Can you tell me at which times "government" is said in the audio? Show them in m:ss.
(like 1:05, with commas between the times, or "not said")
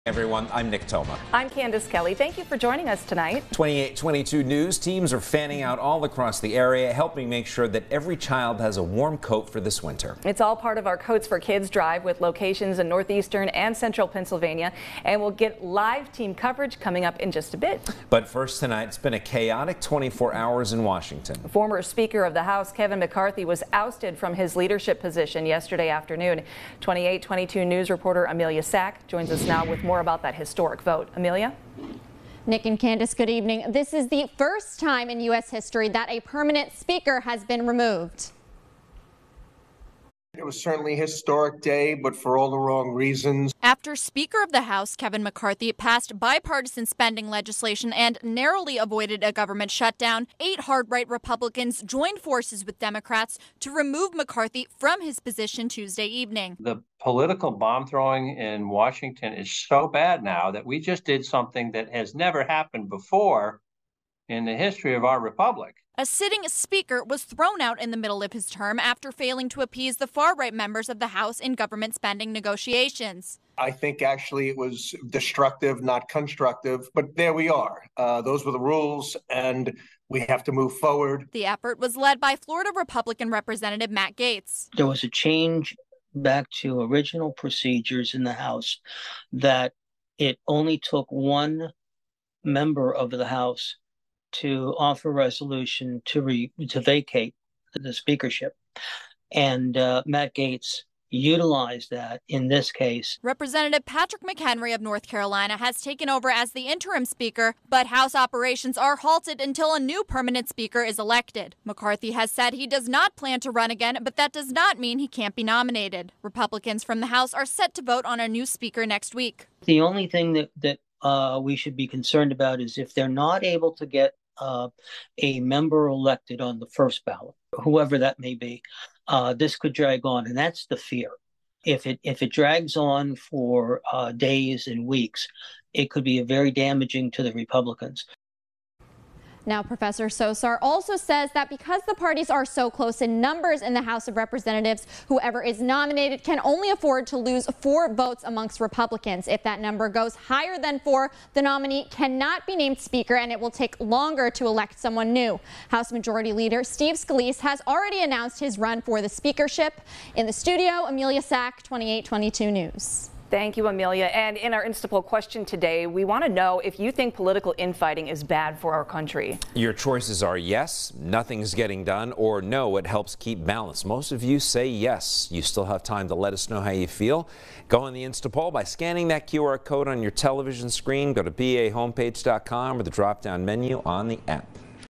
0:49, 1:11.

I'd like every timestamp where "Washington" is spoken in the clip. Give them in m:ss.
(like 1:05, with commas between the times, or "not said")
0:20, 0:58.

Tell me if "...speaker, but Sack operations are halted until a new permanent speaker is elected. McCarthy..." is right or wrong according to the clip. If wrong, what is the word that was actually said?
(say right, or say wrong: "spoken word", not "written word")
wrong: "House", not "Sack".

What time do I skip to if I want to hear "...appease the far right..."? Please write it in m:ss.
1:09.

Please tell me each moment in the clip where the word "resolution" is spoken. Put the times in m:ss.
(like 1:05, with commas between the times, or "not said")
1:35.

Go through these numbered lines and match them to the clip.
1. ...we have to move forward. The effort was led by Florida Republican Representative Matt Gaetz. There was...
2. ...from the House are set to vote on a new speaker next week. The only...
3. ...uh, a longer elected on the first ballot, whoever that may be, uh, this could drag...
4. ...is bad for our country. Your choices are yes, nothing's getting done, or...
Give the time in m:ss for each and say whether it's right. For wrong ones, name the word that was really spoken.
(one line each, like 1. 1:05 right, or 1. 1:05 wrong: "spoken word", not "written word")
1. 1:20 right
2. 1:56 right
3. 2:04 wrong: "member", not "longer"
4. 2:48 right.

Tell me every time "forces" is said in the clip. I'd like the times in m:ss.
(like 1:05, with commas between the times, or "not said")
0:52.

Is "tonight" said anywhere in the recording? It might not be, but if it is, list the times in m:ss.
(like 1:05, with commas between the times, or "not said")
0:03, 0:18.